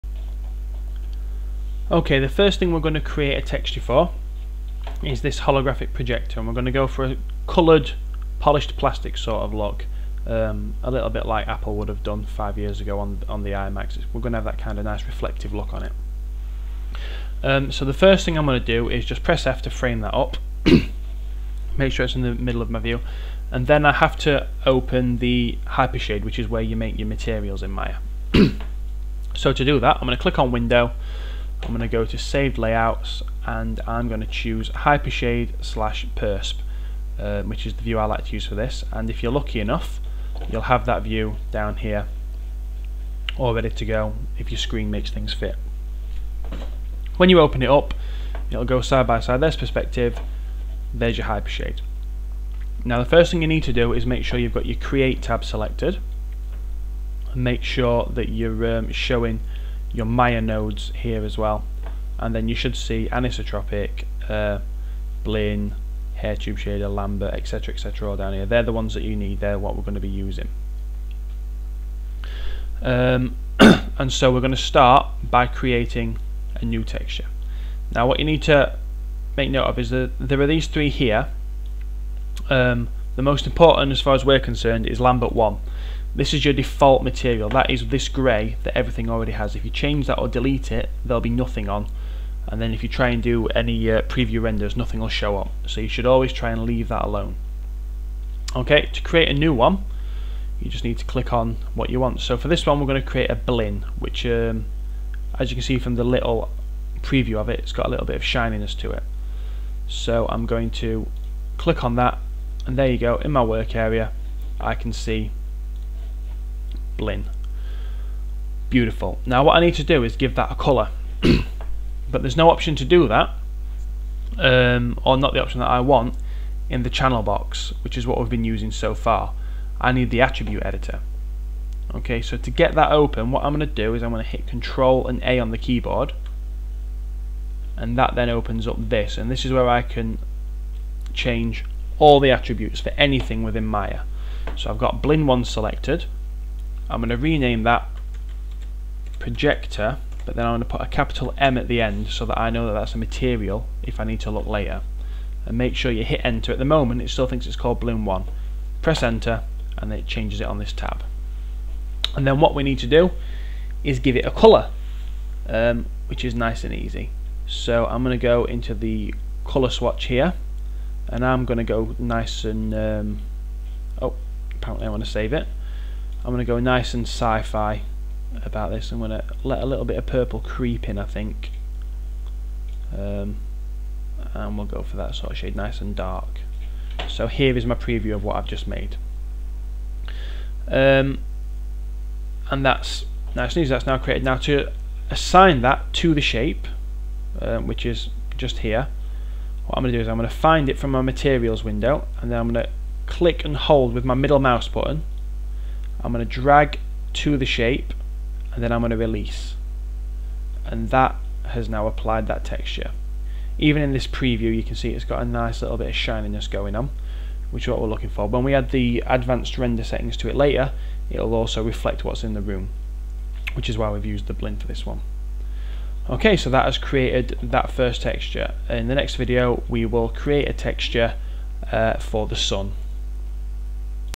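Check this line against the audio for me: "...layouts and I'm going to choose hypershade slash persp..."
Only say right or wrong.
right.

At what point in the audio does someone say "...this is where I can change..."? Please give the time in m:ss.
2:19.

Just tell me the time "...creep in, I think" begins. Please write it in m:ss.
3:00.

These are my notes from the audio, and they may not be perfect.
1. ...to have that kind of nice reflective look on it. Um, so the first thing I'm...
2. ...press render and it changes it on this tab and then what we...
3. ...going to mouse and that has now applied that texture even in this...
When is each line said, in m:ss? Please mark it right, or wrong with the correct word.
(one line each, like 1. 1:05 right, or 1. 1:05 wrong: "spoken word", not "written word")
1. 0:14 right
2. 2:38 wrong: "enter", not "render"
3. 3:28 wrong: "release", not "mouse".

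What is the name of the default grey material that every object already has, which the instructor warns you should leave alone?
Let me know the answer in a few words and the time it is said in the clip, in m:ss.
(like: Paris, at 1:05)
Lambert 1, at 1:24.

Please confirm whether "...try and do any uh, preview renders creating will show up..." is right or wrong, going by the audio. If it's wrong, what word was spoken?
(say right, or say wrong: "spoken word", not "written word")
wrong: "nothing", not "creating".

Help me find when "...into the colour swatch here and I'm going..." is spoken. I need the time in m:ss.
2:48.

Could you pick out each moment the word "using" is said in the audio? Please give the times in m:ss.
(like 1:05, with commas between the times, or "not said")
1:10, 2:08.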